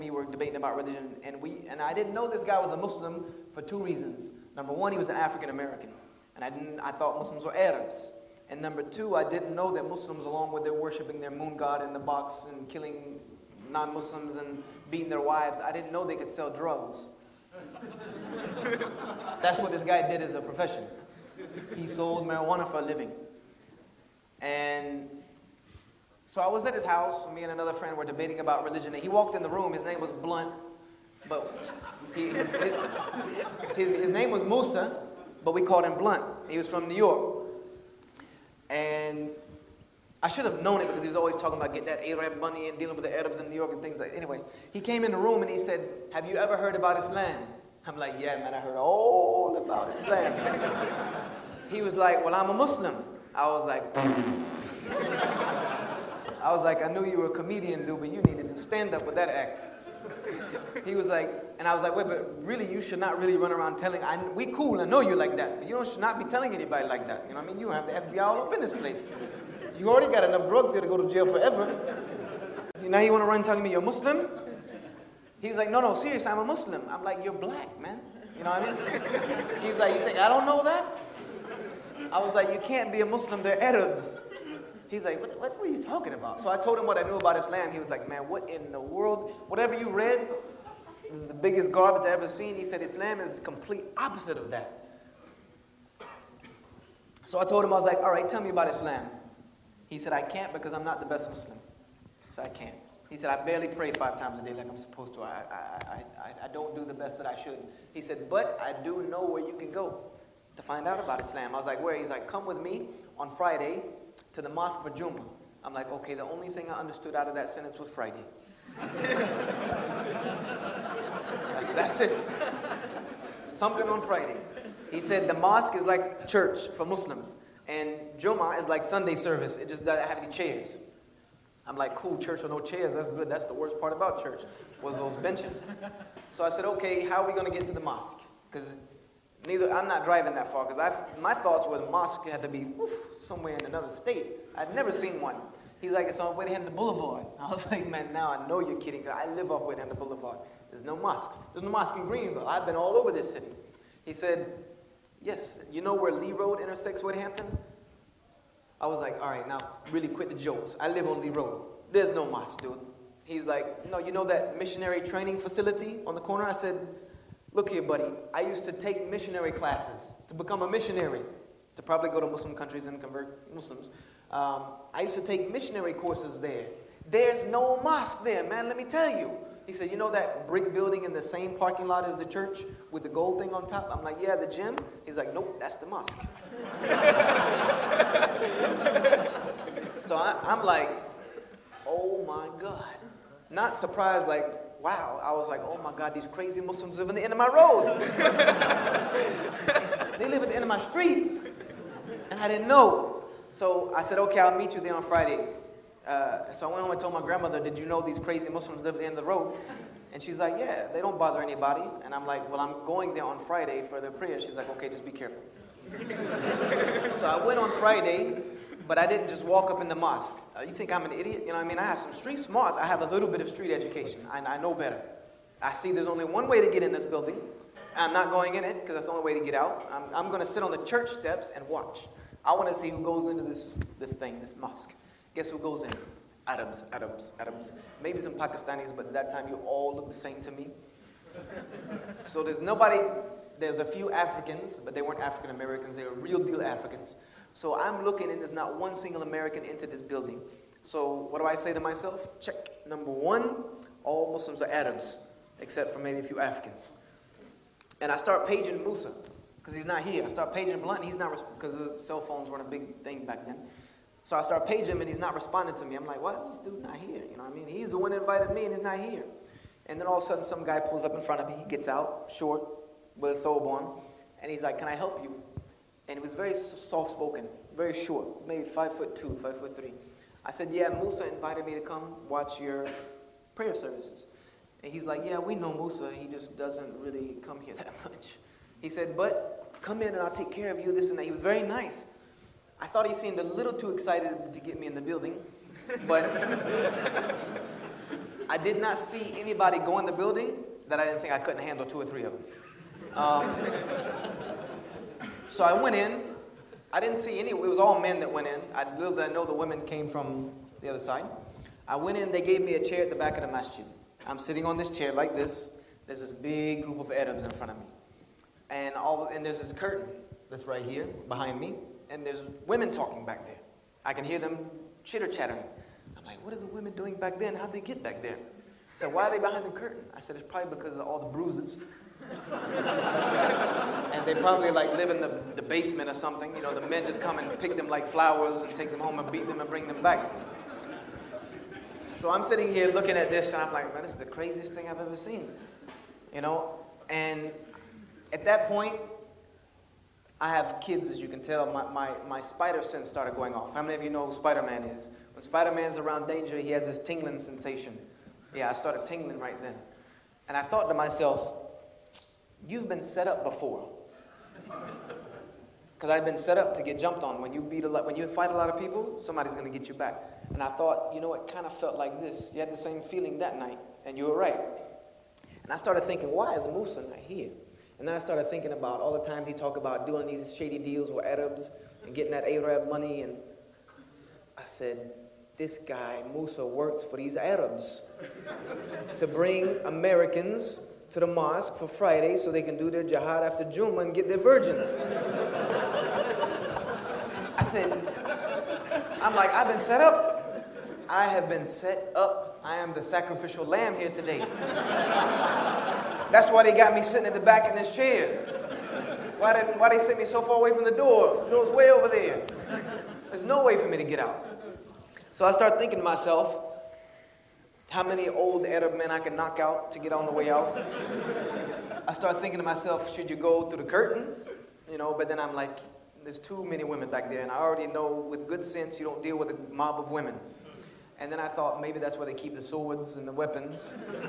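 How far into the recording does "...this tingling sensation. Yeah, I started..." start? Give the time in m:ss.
5:56.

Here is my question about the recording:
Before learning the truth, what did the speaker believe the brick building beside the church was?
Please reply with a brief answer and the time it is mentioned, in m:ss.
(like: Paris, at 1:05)
The gym, at 3:04.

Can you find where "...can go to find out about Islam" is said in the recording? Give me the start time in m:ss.
1:49.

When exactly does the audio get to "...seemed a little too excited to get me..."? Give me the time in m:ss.
4:53.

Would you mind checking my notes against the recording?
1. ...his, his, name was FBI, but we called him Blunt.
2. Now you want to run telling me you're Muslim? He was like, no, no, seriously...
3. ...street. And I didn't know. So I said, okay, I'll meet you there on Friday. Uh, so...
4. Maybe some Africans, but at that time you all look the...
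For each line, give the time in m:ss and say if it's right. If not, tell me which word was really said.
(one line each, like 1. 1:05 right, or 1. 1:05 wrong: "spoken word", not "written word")
1. 0:33 wrong: "Musa", not "FBI"
2. 1:12 right
3. 3:20 right
4. 3:58 wrong: "Pakistanis", not "Africans".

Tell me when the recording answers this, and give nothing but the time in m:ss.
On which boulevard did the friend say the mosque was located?
2:26.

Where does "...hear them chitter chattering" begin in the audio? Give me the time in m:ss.
5:24.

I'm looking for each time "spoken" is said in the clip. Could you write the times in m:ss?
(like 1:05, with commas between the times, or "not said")
4:37.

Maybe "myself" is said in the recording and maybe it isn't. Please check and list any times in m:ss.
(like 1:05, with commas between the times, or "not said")
4:11, 6:00, 6:56, 7:02.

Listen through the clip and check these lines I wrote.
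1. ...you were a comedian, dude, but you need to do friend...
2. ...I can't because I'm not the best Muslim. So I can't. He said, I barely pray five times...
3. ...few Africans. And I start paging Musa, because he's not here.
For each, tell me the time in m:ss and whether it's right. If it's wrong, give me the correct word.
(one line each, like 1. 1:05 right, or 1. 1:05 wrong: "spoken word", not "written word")
1. 0:57 wrong: "stand", not "friend"
2. 1:40 right
3. 4:16 right.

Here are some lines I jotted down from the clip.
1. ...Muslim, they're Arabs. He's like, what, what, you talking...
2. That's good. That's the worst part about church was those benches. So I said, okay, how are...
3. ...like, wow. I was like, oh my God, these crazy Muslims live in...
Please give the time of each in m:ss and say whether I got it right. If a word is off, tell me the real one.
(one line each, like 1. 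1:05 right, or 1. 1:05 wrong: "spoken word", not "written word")
1. 1:23 right
2. 2:12 right
3. 3:14 right.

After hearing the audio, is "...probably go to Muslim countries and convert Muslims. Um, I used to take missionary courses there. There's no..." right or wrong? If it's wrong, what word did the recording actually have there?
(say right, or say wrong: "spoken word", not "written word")
right.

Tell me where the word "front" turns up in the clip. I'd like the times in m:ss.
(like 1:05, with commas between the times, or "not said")
4:31, 5:17.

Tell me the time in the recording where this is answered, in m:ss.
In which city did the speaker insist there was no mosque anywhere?
2:31.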